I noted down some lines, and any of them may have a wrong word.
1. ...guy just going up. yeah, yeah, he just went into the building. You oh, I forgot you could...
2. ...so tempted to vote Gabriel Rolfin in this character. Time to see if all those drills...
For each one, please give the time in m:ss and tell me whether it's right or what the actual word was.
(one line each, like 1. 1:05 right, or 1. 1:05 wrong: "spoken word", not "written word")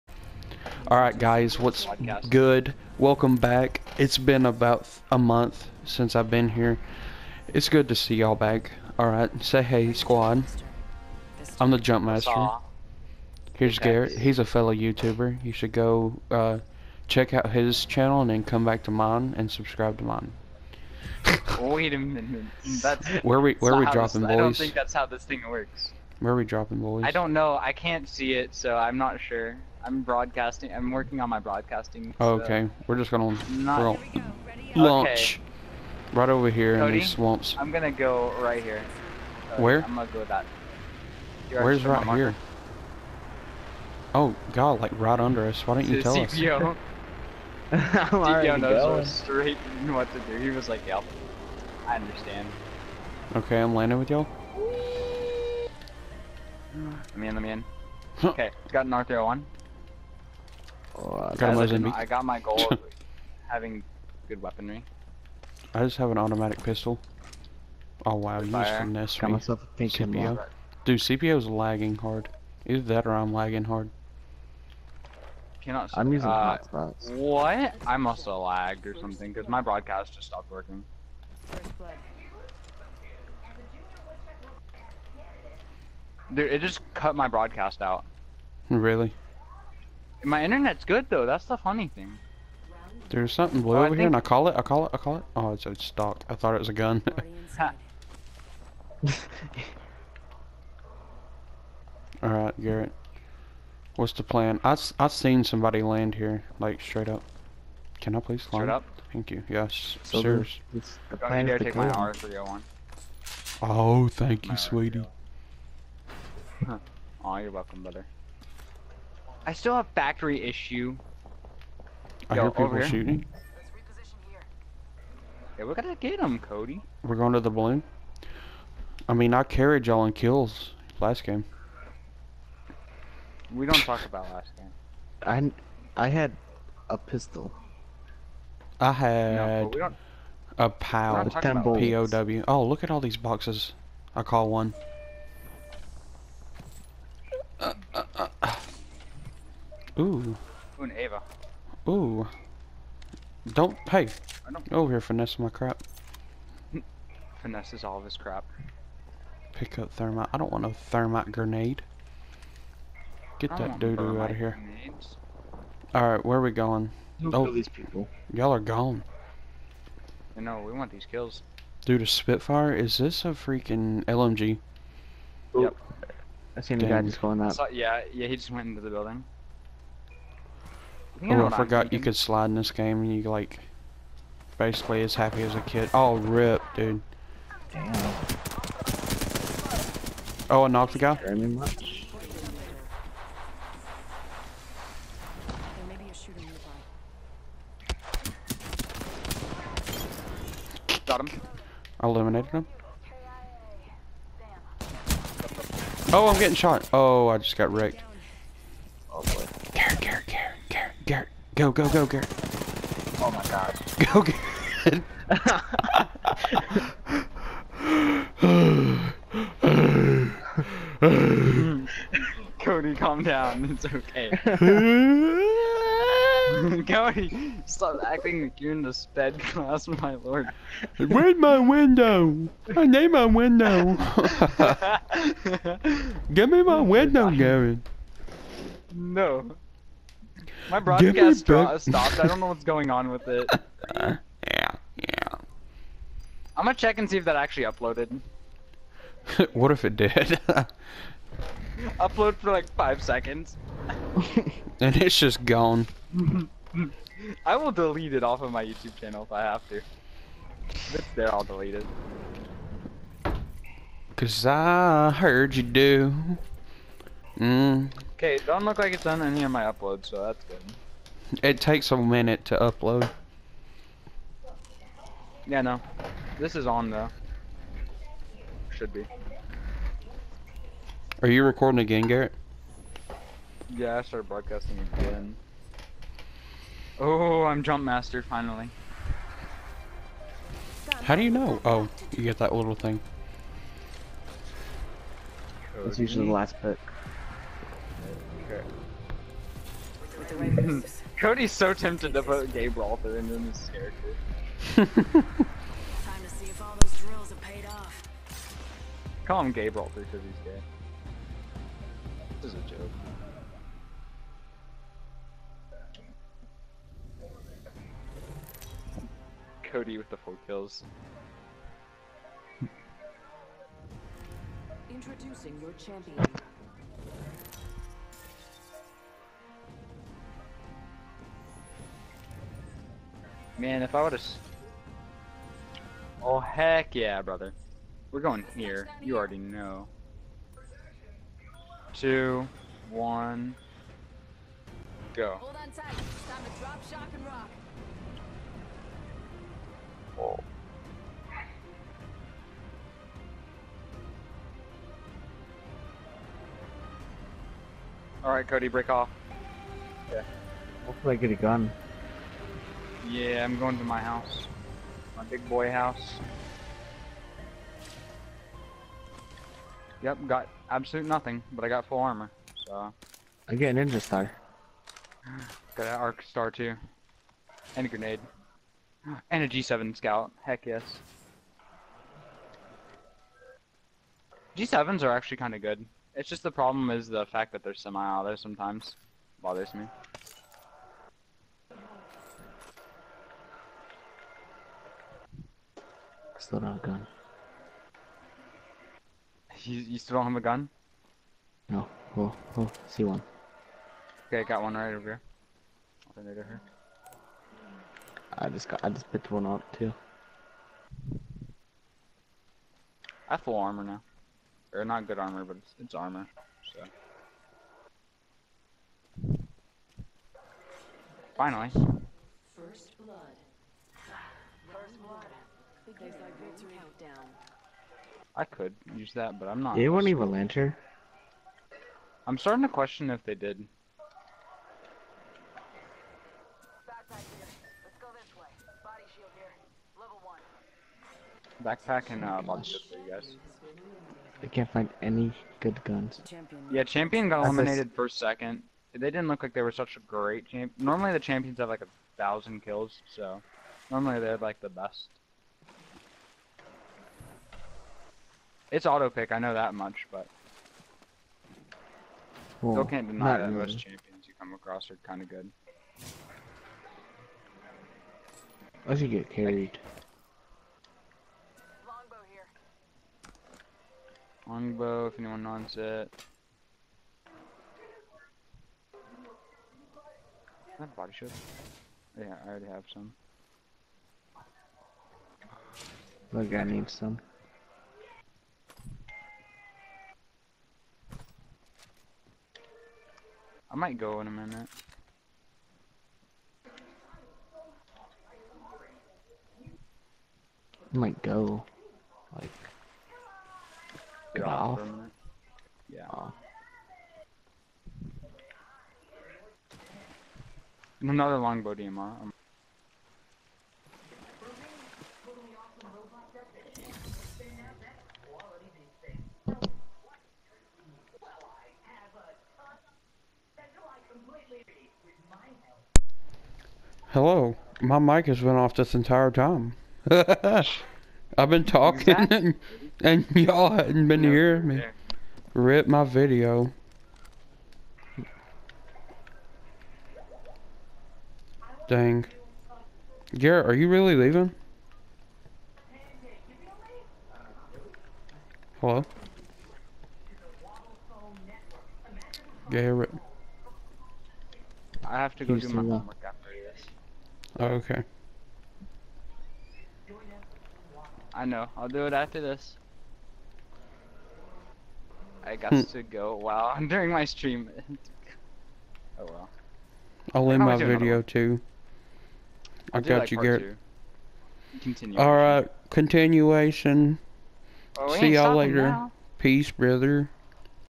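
1. 2:56 right
2. 5:01 right.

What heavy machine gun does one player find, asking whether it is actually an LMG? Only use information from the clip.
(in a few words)
Spitfire.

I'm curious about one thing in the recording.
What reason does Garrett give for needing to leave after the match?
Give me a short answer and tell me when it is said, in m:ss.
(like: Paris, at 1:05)
homework, at 9:15.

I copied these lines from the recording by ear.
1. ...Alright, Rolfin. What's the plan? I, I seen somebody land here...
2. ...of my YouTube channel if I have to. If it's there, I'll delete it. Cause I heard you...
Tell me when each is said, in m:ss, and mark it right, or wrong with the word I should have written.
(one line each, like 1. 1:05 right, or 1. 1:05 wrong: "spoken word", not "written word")
1. 1:42 wrong: "Garrett", not "Rolfin"
2. 4:18 right.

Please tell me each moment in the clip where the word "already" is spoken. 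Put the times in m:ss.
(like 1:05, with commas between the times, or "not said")
5:39, 8:02.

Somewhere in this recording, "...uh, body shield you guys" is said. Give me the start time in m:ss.
7:22.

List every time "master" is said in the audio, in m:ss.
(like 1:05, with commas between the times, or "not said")
0:12, 4:47.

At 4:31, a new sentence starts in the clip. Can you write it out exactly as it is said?
It takes a minute to upload.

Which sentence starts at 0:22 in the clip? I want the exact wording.
That's where we where we dropping this, boys.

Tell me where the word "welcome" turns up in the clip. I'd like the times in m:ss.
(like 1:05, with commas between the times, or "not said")
0:02, 1:57.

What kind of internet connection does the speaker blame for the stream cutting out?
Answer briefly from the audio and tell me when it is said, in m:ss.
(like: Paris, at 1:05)
hotspots, at 1:16.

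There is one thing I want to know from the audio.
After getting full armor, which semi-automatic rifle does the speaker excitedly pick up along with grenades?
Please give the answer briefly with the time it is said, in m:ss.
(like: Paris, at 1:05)
G7 scout, at 6:19.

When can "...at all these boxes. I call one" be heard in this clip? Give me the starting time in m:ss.
2:22.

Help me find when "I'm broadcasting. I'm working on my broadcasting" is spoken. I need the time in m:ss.
0:29.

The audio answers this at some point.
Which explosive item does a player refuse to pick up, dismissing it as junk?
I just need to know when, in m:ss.
2:40.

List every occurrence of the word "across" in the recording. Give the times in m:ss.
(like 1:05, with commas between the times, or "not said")
7:44.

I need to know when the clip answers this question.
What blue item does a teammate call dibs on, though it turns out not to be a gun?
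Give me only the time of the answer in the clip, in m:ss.
1:35.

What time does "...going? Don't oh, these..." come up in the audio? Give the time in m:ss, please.
2:46.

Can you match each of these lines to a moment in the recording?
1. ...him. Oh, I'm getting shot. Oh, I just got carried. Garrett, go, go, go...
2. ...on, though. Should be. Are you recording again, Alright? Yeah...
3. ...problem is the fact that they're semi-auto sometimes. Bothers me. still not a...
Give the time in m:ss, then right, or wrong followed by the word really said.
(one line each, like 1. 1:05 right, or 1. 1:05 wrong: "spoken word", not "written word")
1. 3:22 wrong: "wrecked", not "carried"
2. 4:36 wrong: "Garrett", not "Alright"
3. 6:26 right.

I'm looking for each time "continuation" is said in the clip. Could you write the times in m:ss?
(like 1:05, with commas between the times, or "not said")
9:35.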